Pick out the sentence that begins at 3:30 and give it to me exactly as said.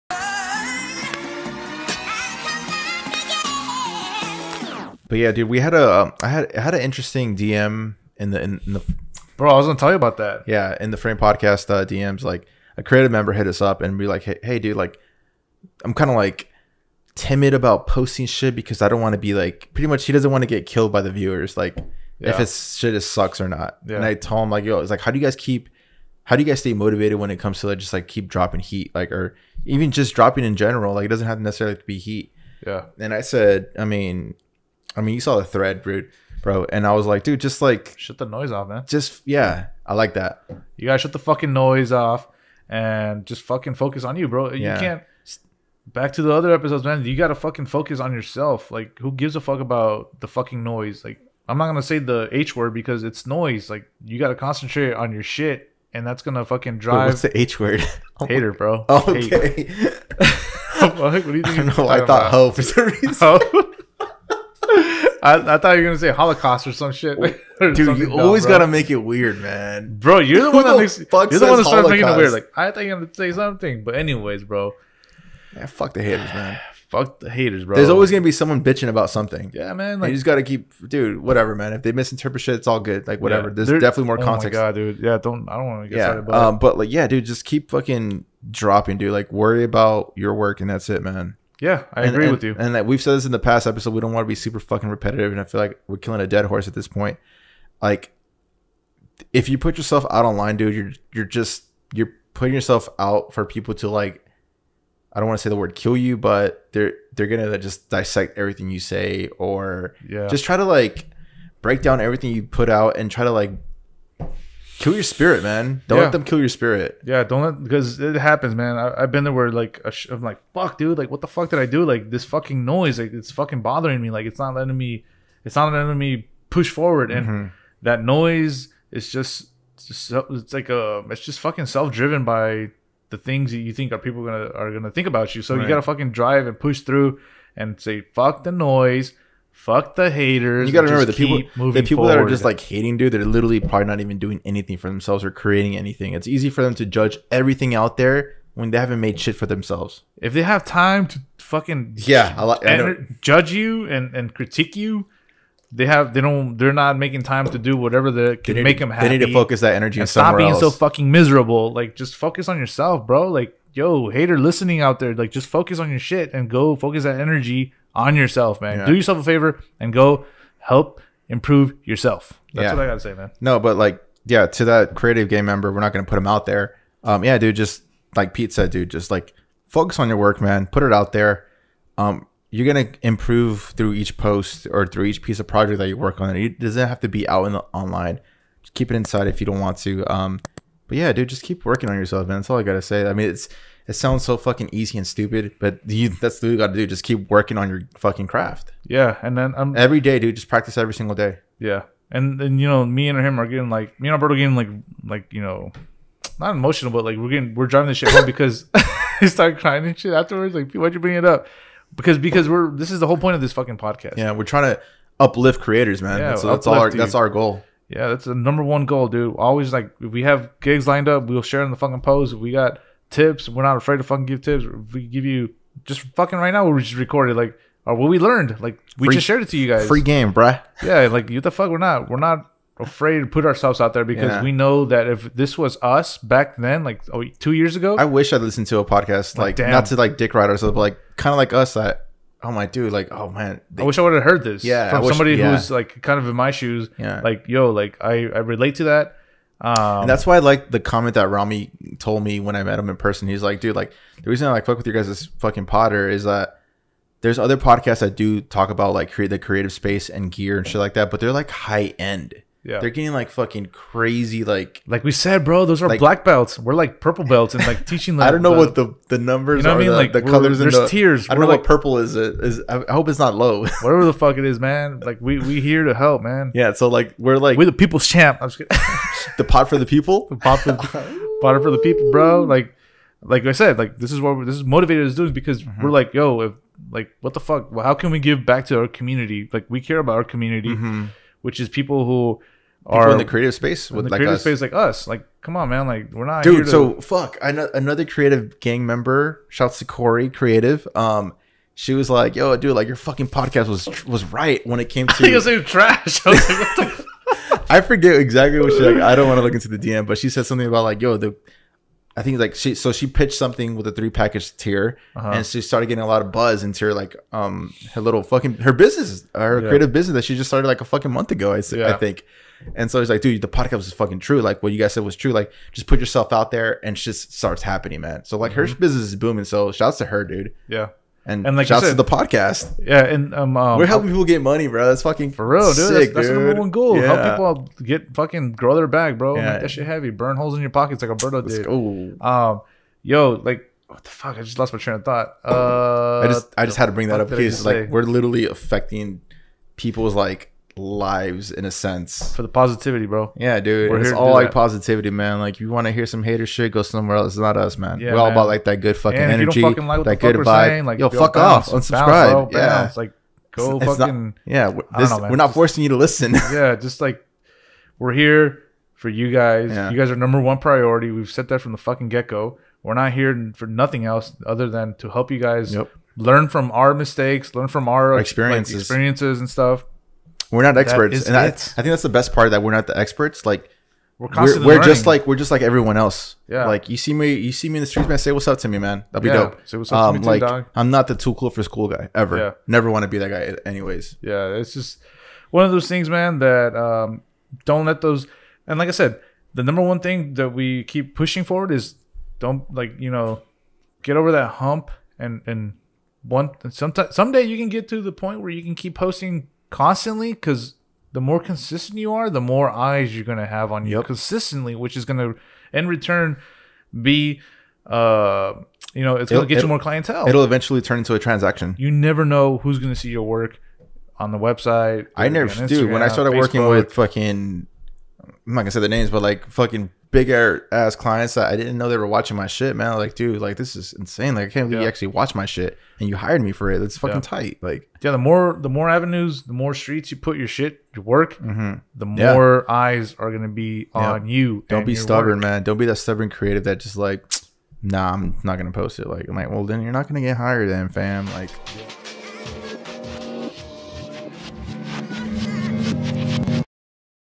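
Like, why'd you bring it up?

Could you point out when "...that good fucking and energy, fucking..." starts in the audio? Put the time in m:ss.
5:58.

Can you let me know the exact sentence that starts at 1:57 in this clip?
Yeah, don't let because it happens, man.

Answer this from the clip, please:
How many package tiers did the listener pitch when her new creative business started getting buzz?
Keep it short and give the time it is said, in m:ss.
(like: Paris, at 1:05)
3, at 5:13.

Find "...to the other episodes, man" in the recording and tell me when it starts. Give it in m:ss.
0:46.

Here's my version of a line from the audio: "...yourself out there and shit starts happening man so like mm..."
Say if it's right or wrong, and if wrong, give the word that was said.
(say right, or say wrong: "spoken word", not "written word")
right.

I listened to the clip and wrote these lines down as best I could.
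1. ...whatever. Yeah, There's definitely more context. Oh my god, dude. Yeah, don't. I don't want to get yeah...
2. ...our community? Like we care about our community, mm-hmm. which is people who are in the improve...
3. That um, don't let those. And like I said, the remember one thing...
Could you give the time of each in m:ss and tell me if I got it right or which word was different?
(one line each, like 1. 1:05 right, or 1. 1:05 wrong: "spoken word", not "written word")
1. 1:23 right
2. 4:48 wrong: "creative", not "improve"
3. 6:36 wrong: "number", not "remember".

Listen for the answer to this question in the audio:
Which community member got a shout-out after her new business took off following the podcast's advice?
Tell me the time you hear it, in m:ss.
4:59.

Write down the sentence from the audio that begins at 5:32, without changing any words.
Yeah, and um, um, we're helping people get money, bro.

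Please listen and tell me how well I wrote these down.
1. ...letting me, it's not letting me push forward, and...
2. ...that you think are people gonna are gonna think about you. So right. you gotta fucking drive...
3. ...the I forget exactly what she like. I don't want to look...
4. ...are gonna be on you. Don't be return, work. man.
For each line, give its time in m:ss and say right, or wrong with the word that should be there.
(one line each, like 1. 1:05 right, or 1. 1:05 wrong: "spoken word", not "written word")
1. 2:04 right
2. 2:13 right
3. 5:06 right
4. 7:23 wrong: "stubborn", not "return".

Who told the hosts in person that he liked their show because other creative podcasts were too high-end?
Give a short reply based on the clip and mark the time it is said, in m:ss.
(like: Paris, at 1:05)
Rami, at 4:11.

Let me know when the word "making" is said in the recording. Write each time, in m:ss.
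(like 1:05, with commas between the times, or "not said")
1:11, 2:36.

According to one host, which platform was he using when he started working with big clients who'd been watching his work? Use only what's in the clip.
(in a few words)
Facebook.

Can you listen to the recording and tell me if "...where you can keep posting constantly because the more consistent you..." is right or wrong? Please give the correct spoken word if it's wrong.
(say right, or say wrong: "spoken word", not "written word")
right.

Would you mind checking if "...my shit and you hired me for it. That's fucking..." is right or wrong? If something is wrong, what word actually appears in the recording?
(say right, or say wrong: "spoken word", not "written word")
right.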